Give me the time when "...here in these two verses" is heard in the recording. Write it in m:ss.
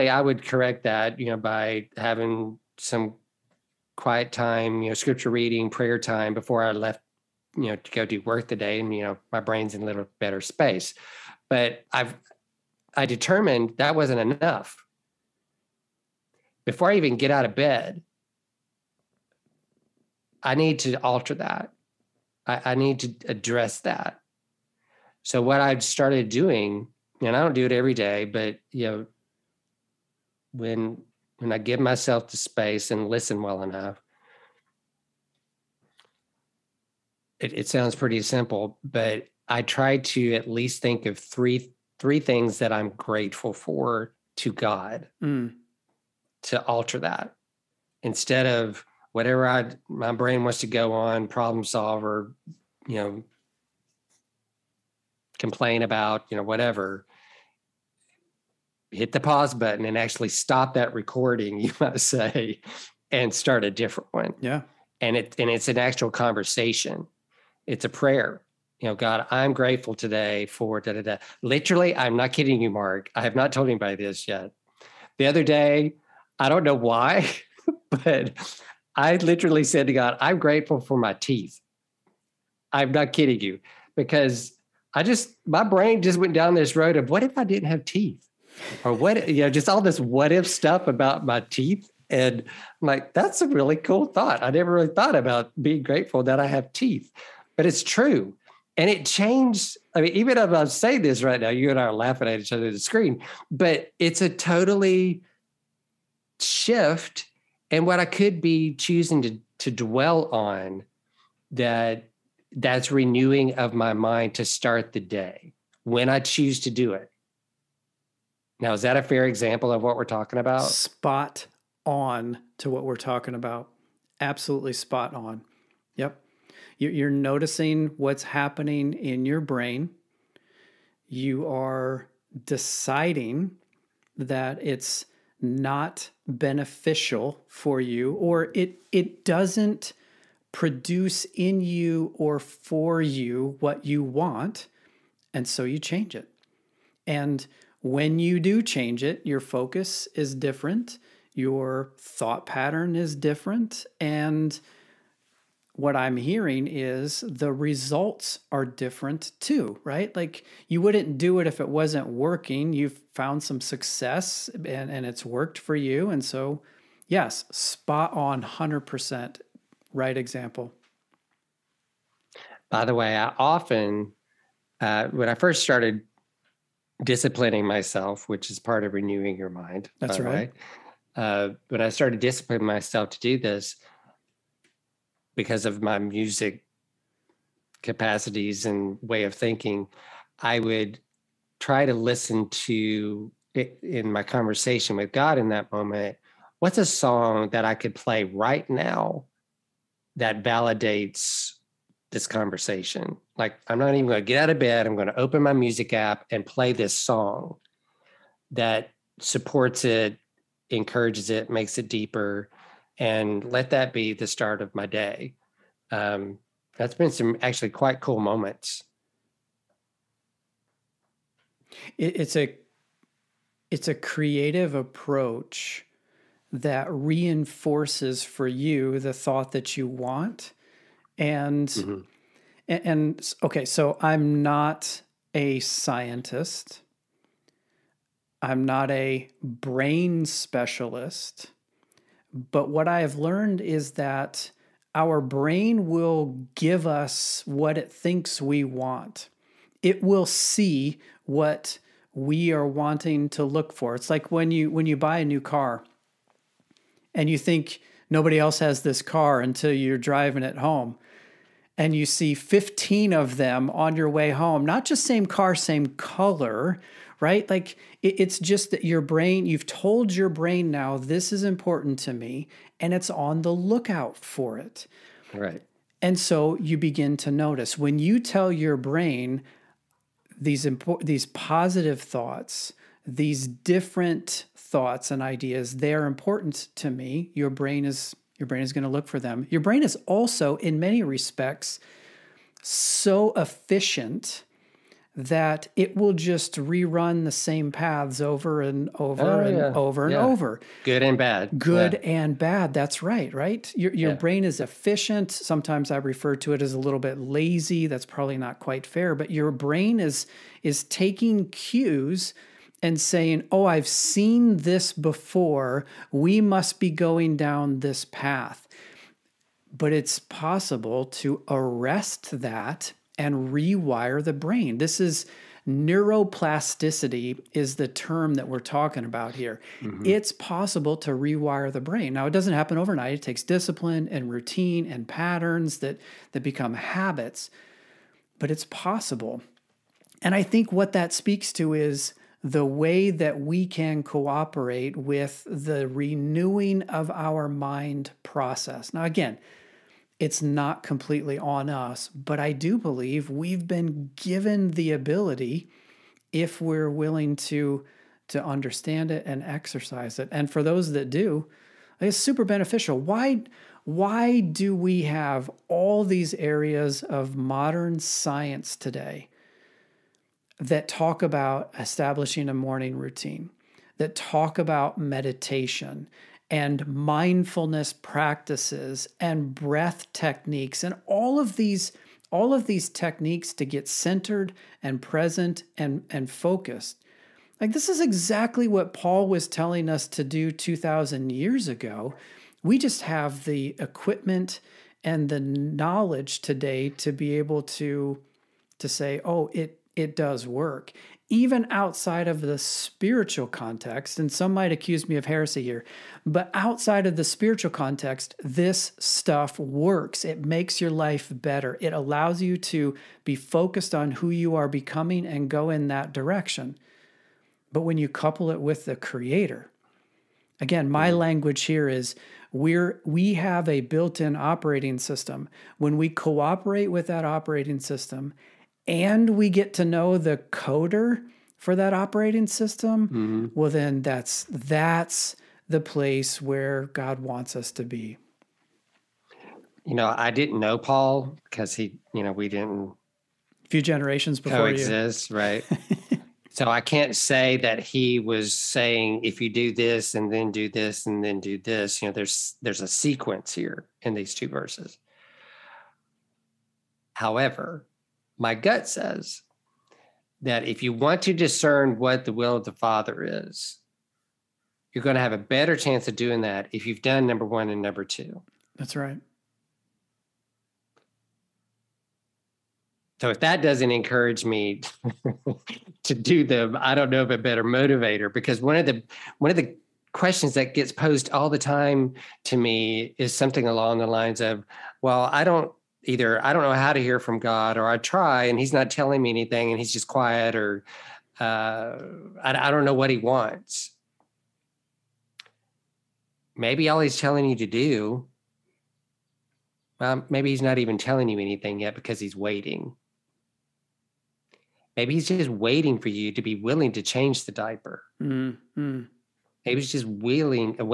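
7:33.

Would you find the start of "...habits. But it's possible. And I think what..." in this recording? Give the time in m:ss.
5:36.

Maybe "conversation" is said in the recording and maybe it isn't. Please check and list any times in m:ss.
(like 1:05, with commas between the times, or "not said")
1:06, 3:14, 3:22.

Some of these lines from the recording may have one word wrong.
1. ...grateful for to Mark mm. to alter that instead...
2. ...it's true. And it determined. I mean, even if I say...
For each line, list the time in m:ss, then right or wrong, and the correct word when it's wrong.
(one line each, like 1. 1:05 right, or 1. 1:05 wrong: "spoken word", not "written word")
1. 0:42 wrong: "God", not "Mark"
2. 1:37 wrong: "changed", not "determined".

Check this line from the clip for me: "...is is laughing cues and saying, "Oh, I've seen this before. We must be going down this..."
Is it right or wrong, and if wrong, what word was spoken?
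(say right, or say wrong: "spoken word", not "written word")
wrong: "taking", not "laughing".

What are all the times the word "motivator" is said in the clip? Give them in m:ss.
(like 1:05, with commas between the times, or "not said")
7:57.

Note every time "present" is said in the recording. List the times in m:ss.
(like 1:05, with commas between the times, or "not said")
6:25.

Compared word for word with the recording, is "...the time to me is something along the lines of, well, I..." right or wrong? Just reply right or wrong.
right.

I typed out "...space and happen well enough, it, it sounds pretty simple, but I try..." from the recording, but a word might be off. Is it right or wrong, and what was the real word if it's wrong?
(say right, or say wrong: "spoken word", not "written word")
wrong: "listen", not "happen".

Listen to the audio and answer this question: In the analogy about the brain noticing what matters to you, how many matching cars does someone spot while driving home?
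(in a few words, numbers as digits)
15.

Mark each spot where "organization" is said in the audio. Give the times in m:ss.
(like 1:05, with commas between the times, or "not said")
not said.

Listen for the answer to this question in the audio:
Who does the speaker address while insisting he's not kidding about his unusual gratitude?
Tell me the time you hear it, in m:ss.
1:12.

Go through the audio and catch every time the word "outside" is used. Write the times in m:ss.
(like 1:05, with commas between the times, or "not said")
6:41, 6:46.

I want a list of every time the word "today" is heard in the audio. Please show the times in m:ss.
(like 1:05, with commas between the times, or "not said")
1:09, 6:08, 6:36.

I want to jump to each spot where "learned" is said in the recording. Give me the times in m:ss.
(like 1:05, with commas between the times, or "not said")
4:03.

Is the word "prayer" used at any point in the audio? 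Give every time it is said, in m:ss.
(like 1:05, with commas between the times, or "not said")
0:05, 1:07.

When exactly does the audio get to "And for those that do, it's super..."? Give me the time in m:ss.
6:00.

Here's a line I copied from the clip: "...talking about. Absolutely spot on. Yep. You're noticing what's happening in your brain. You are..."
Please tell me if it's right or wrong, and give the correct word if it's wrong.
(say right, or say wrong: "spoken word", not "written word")
right.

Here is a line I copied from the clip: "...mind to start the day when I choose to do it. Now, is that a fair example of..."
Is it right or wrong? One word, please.
right.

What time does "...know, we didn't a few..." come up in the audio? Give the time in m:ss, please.
7:22.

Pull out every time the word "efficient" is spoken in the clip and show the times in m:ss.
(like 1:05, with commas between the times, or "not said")
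4:53, 5:04.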